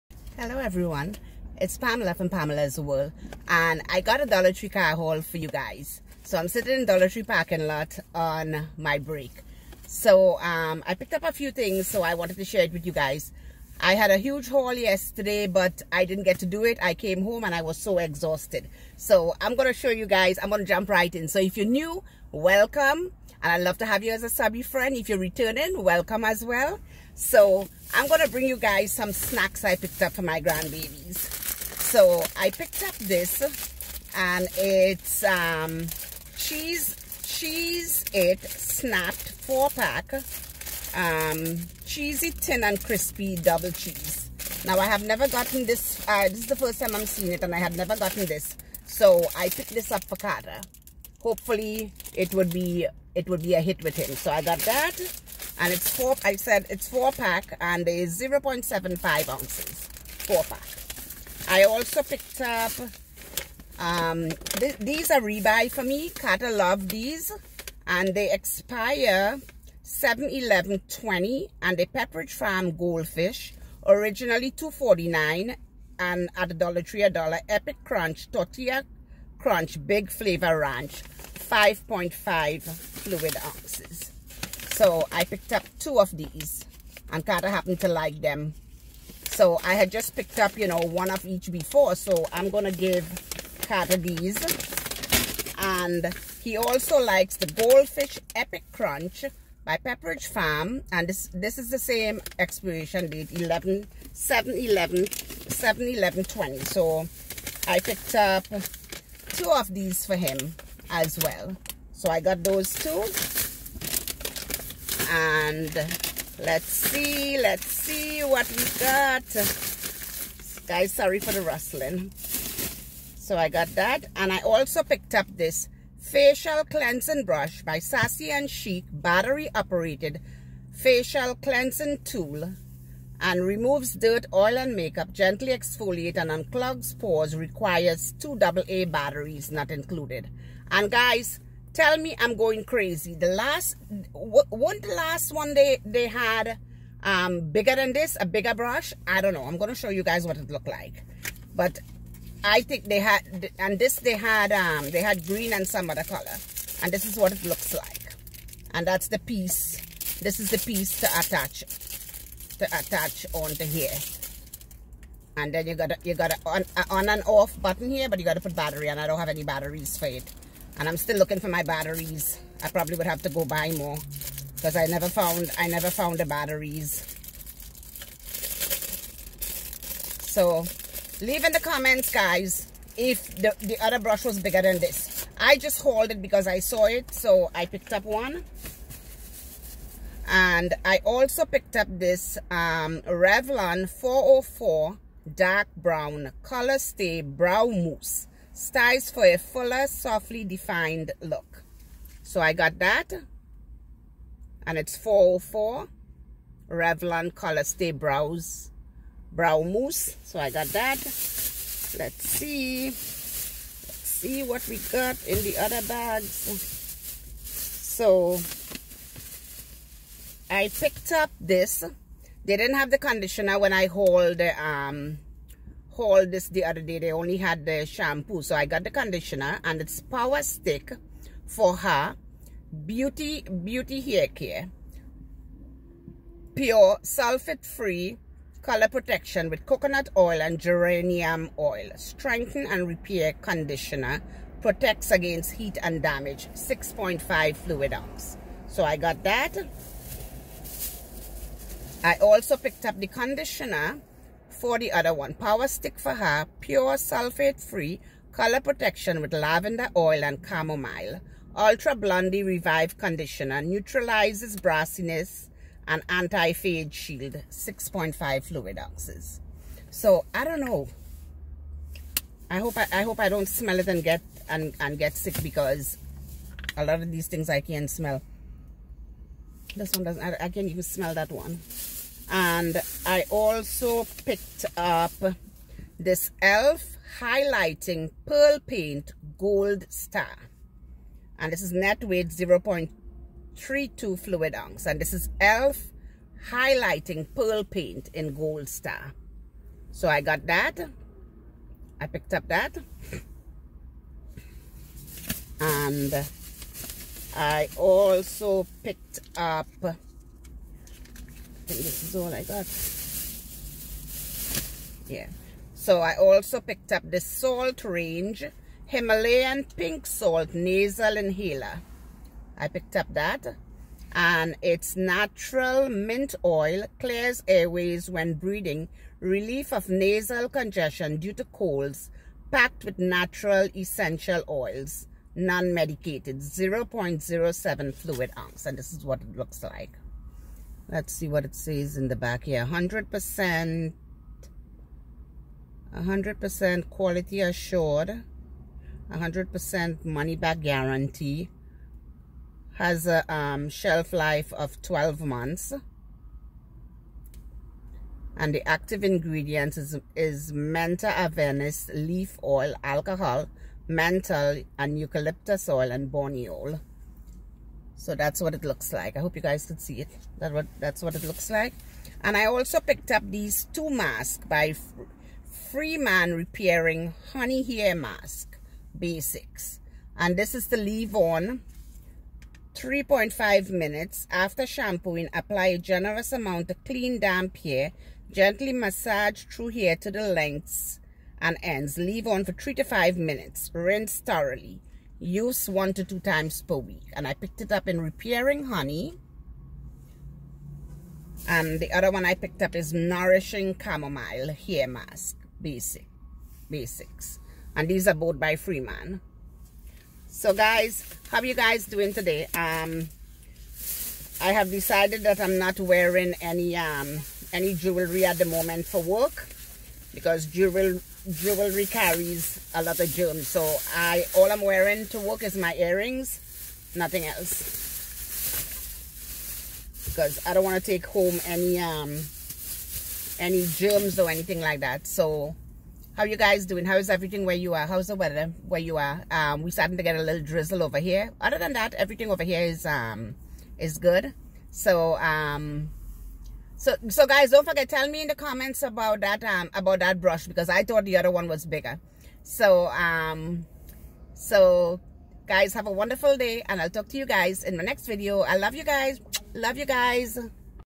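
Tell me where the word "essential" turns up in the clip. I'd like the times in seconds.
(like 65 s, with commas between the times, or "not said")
333 s.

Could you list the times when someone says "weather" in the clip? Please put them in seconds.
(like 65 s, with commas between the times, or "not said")
438 s.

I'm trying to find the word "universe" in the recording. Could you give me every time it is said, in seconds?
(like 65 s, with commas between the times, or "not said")
not said.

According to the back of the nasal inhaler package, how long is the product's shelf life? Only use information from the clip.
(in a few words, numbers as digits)
12 months.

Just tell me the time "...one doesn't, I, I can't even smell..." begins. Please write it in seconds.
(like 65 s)
279 s.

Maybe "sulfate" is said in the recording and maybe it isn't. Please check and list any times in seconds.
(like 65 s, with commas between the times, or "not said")
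237 s, 256 s.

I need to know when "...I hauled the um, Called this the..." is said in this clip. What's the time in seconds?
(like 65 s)
223 s.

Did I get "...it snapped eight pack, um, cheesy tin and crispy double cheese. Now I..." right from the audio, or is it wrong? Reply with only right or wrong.
wrong.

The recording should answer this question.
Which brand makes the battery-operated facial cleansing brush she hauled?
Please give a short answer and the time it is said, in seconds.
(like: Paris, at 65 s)
Sassy and Chic, at 127 s.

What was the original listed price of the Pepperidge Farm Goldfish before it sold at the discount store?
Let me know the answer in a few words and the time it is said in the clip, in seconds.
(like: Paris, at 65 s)
249, at 73 s.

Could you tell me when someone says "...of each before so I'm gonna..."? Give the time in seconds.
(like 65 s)
91 s.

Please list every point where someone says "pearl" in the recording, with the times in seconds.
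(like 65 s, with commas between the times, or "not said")
288 s, 297 s.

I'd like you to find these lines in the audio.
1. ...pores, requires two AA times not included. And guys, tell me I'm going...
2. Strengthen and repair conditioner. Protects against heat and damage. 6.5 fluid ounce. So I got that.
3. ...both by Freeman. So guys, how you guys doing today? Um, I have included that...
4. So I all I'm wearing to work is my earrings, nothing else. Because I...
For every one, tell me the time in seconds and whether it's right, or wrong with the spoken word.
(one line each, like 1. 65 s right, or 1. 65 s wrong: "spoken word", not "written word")
1. 136 s wrong: "batteries", not "times"
2. 241 s right
3. 408 s wrong: "decided", not "included"
4. 423 s right.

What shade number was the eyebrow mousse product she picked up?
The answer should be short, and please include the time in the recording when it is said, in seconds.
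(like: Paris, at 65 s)
404, at 193 s.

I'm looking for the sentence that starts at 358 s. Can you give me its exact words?
And the active ingredients is, is mentha leaf oil, alcohol, menthol, and eucalyptus oil, and borneol.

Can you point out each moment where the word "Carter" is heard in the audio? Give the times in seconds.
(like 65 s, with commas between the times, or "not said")
50 s, 66 s, 93 s.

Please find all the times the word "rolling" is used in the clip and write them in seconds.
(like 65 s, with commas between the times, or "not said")
not said.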